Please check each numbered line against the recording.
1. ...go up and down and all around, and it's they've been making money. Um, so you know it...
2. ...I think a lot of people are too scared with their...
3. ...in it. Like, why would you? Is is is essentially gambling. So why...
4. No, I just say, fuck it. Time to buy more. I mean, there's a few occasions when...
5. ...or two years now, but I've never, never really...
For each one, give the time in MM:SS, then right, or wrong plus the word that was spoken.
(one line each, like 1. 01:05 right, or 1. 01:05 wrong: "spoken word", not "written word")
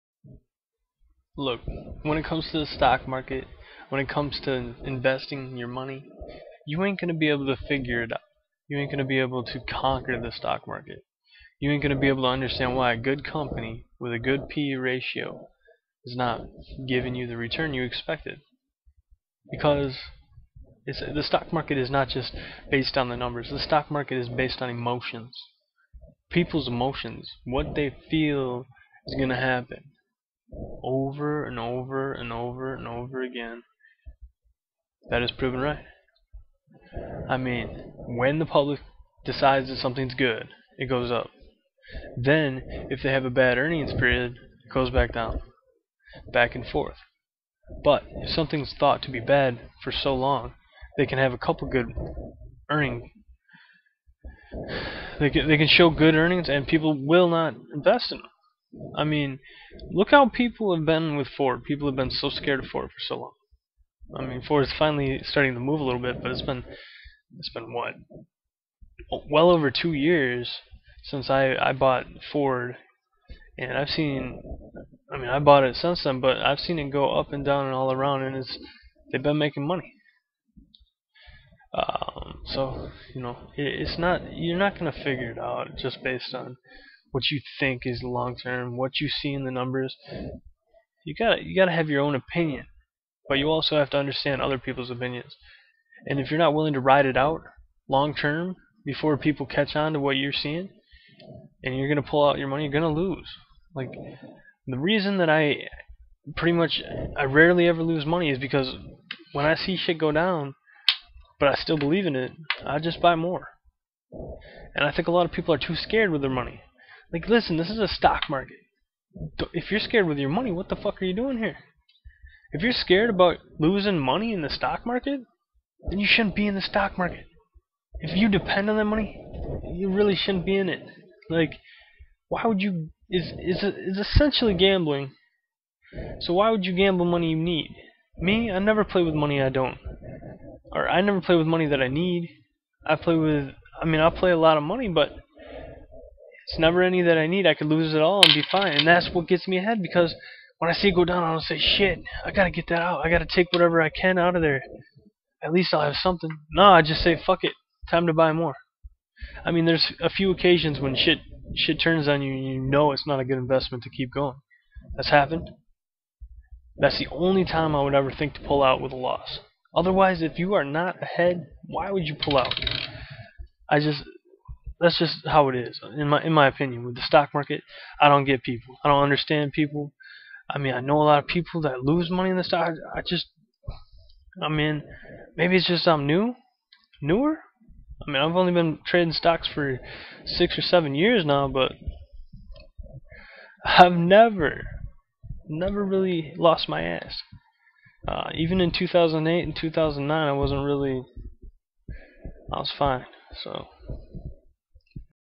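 1. 01:16 right
2. 01:54 right
3. 02:10 right
4. 02:36 right
5. 03:10 wrong: "seven", not "two".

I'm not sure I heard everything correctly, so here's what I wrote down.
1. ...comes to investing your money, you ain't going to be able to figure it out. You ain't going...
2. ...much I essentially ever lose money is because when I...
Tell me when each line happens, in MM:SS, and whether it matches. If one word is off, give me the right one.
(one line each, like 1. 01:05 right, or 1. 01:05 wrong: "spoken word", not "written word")
1. 00:04 right
2. 01:46 wrong: "rarely", not "essentially".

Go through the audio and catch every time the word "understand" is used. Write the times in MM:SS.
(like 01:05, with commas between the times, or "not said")
00:12, 01:33, 02:59.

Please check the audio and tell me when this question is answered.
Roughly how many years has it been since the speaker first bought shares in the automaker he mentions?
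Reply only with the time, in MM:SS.
01:09.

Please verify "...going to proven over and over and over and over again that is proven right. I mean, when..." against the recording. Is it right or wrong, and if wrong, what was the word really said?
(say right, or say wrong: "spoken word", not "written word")
wrong: "happen", not "proven".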